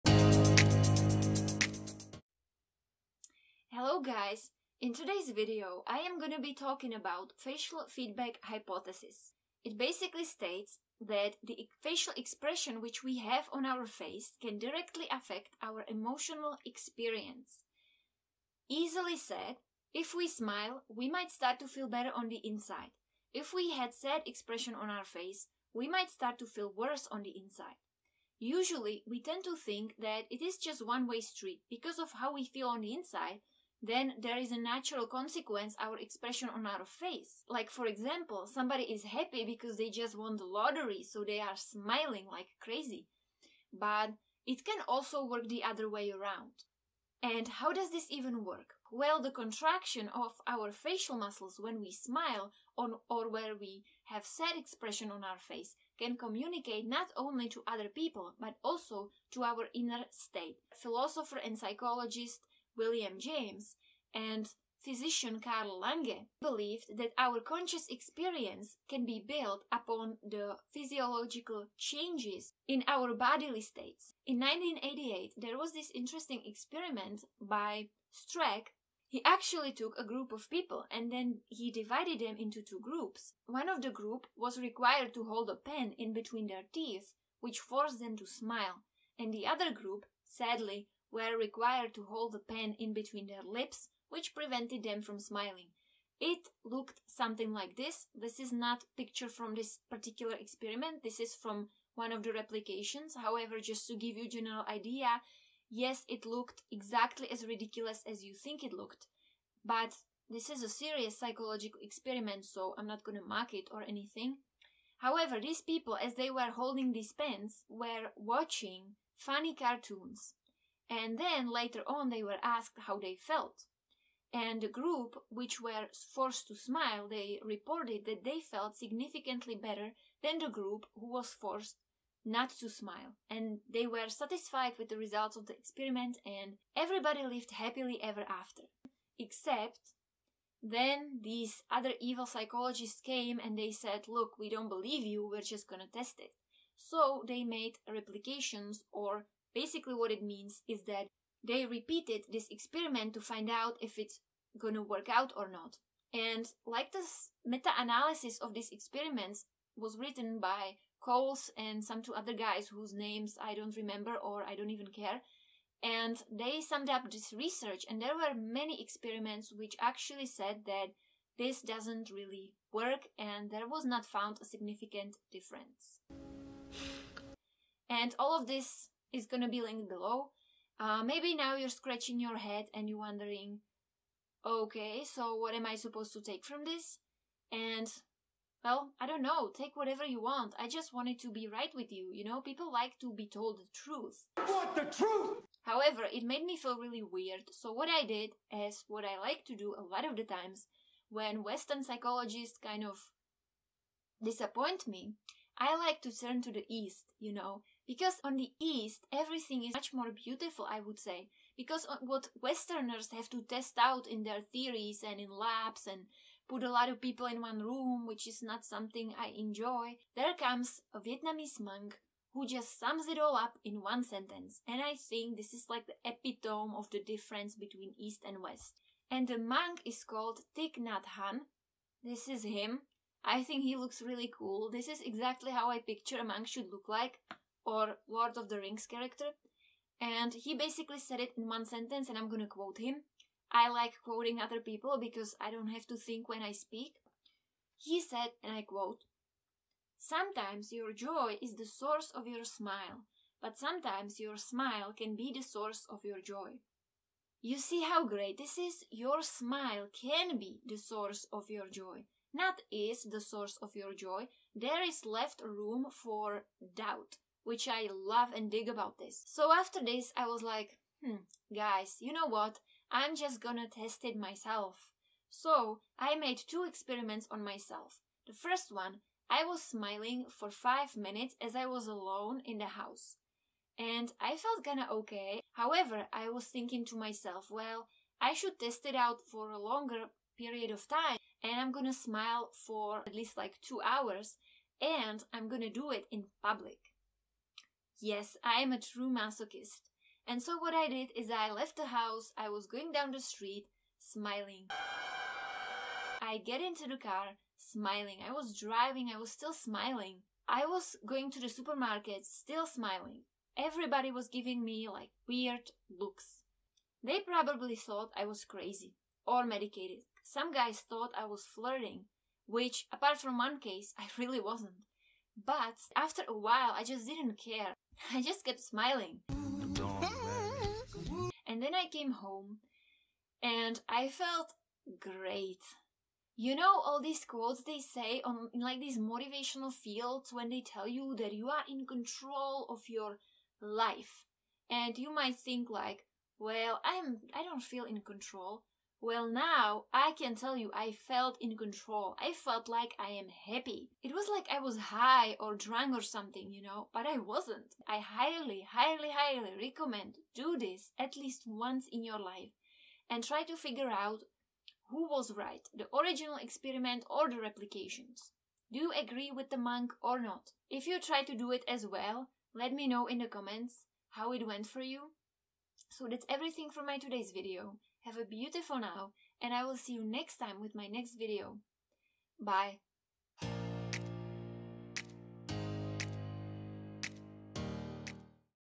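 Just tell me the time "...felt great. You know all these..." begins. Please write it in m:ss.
5:34.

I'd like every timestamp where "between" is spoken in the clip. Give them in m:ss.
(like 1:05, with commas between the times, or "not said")
1:26, 1:32, 3:47.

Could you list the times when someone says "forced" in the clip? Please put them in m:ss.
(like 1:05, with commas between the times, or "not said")
1:27, 2:06, 2:11.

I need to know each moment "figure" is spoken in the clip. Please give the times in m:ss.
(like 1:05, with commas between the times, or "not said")
6:03.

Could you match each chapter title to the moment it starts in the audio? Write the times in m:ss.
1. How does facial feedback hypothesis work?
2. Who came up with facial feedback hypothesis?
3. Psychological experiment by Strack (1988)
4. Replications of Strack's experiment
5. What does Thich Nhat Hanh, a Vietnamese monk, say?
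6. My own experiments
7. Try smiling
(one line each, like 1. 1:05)
1. 0:47
2. 1:00
3. 1:14
4. 2:20
5. 3:17
6. 4:29
7. 5:58.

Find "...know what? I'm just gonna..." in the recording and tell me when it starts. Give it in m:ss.
4:32.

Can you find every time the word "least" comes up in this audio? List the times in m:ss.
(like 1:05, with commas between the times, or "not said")
4:53, 6:01.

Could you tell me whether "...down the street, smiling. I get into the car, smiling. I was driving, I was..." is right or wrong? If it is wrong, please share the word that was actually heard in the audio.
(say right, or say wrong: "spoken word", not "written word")
right.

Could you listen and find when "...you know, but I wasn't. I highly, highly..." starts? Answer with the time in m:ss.
5:56.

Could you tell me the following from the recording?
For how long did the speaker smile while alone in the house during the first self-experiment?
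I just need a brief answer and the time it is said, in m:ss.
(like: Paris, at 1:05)
5 minutes, at 4:40.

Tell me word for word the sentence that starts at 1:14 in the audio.
In 1988, there was this interesting experiment by Strack.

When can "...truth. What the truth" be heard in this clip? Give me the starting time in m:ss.
3:13.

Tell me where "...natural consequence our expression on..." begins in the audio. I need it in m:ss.
0:34.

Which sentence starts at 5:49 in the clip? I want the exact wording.
Well, now I can tell you I felt in control.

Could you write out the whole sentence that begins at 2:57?
And all of this is gonna be linked below.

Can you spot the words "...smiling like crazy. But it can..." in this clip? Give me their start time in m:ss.
0:41.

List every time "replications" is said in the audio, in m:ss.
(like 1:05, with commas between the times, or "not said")
1:42, 2:27, 6:07.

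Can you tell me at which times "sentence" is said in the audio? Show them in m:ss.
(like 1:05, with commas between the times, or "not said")
3:44, 4:01.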